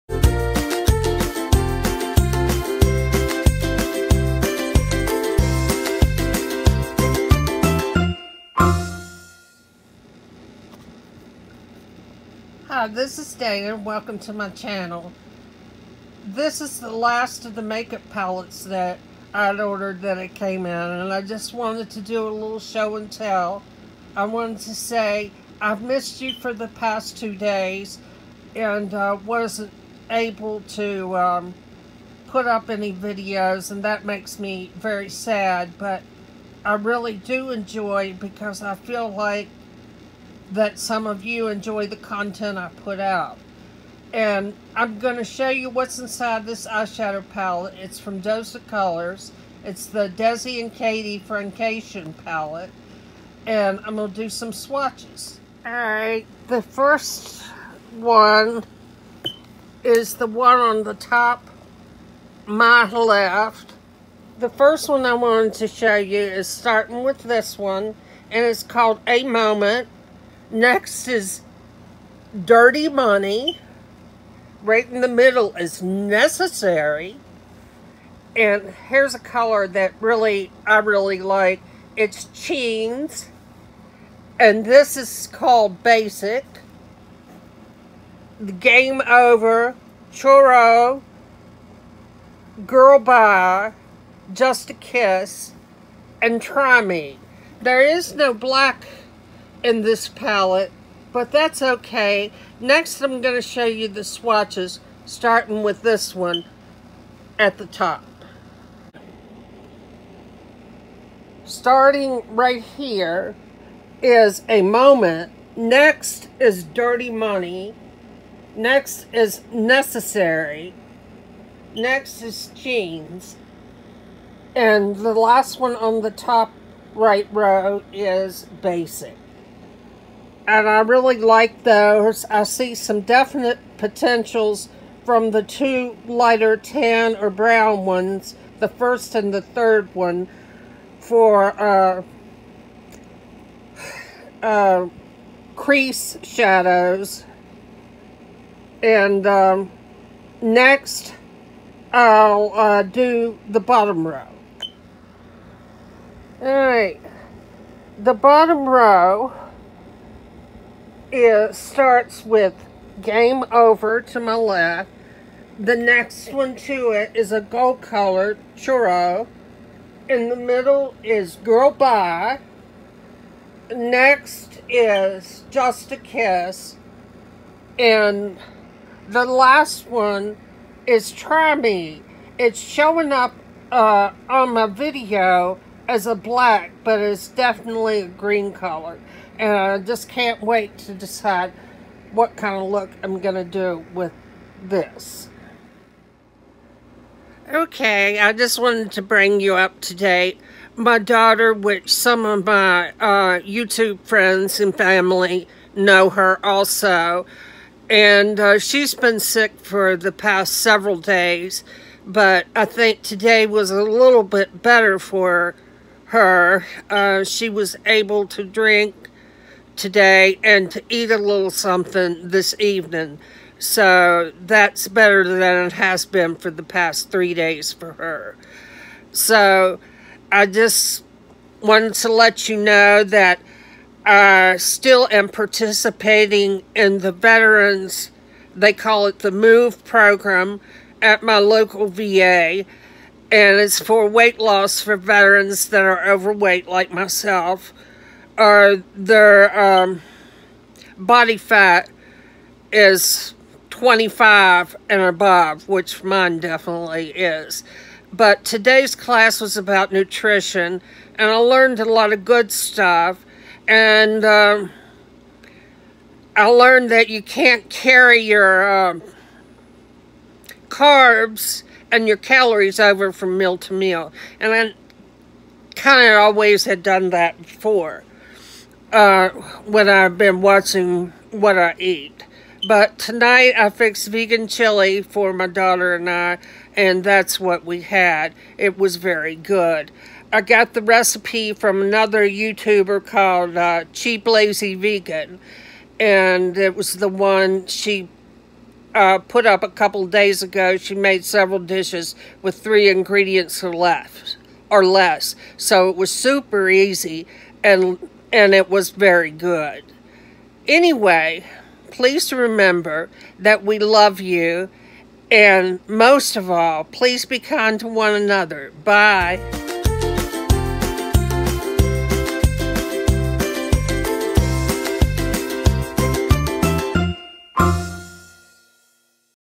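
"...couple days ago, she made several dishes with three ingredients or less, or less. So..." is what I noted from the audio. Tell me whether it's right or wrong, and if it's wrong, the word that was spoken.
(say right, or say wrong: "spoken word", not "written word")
right.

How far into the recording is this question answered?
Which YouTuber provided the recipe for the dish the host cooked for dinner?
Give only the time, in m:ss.
4:53.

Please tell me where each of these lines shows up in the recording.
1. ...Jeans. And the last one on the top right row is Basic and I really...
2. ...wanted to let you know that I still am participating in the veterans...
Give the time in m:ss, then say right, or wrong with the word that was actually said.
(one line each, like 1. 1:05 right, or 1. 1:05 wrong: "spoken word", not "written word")
1. 2:02 right
2. 3:51 right.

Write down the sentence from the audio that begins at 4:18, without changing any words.
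But today's class was about nutrition, and I learned a lot of good stuff.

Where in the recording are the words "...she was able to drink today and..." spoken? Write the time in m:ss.
3:37.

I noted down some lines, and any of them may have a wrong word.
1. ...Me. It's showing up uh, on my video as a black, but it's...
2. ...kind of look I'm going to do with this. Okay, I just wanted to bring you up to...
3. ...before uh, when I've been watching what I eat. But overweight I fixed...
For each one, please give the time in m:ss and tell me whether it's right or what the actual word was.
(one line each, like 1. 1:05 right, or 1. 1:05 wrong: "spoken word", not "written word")
1. 3:01 right
2. 3:12 right
3. 4:37 wrong: "tonight", not "overweight".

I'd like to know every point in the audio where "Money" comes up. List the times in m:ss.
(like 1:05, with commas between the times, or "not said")
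1:12, 1:57.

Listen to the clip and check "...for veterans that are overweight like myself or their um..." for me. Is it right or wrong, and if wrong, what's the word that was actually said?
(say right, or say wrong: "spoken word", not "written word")
right.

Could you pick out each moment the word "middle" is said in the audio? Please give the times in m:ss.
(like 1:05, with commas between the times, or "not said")
1:15, 2:50.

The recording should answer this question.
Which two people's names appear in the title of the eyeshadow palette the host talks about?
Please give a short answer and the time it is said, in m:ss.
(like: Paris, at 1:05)
Desi and Katie, at 0:50.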